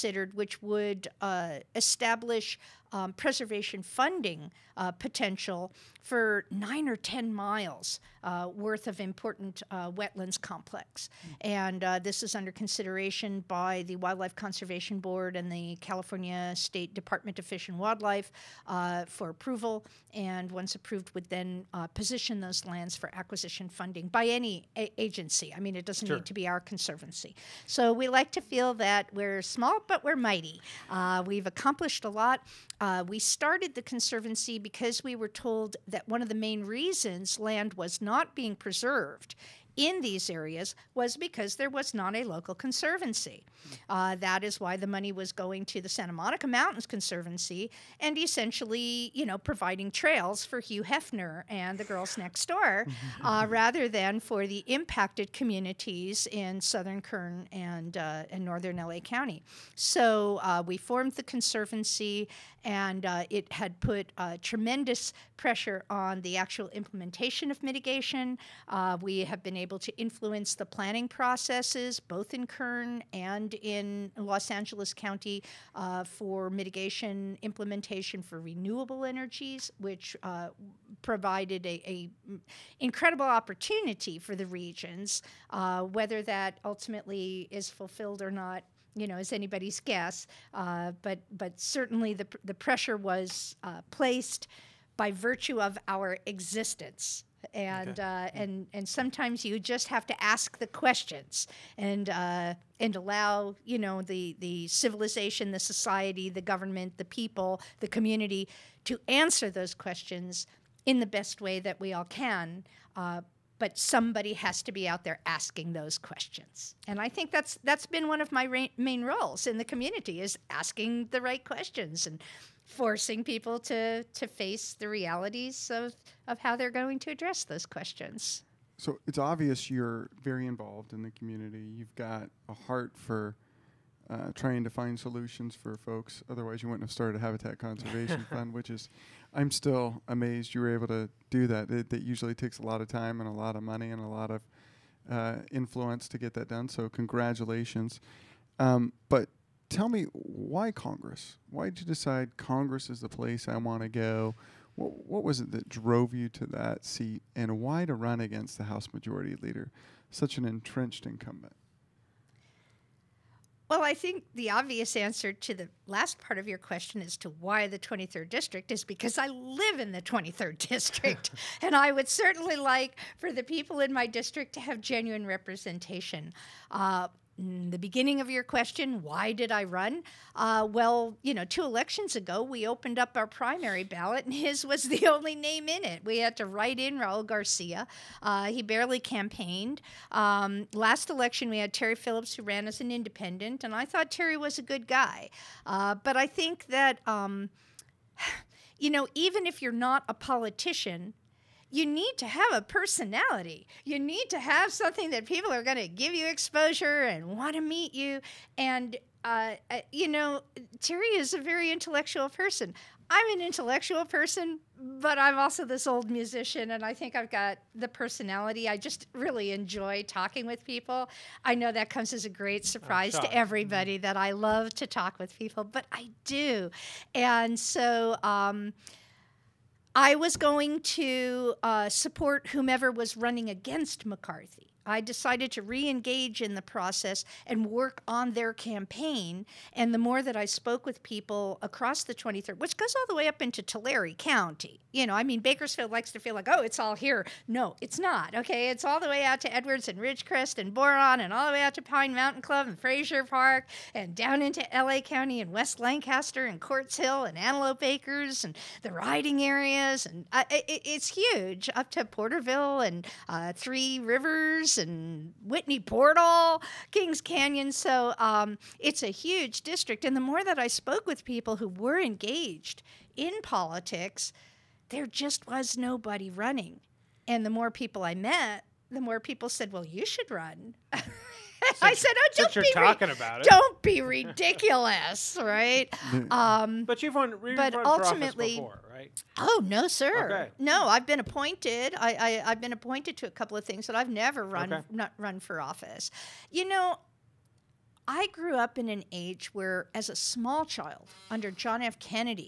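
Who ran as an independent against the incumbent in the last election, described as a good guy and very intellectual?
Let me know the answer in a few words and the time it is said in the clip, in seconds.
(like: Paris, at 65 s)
Terry Phillips, at 191 s.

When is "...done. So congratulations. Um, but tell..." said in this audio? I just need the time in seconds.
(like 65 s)
146 s.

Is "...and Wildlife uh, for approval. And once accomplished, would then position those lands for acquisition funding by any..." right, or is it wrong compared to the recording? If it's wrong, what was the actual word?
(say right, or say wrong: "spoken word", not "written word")
wrong: "approved", not "accomplished".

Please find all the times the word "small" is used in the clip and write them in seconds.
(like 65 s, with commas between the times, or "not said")
29 s, 300 s.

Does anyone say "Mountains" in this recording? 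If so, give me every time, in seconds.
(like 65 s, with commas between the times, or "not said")
46 s, 252 s.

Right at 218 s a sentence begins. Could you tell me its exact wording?
I just really enjoy talking with people.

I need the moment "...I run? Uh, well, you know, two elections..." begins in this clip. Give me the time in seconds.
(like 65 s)
179 s.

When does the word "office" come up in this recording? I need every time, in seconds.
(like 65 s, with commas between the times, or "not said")
295 s.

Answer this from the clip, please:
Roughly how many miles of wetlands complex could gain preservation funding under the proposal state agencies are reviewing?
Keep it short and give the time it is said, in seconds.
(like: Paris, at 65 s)
9 or 10, at 6 s.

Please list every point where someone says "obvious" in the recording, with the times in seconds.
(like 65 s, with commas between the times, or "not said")
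129 s, 164 s.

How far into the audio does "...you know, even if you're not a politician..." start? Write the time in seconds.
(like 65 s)
198 s.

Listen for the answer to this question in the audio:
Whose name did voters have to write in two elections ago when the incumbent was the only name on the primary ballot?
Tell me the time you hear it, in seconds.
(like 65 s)
186 s.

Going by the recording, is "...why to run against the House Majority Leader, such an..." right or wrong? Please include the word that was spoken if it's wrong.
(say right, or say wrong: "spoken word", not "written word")
right.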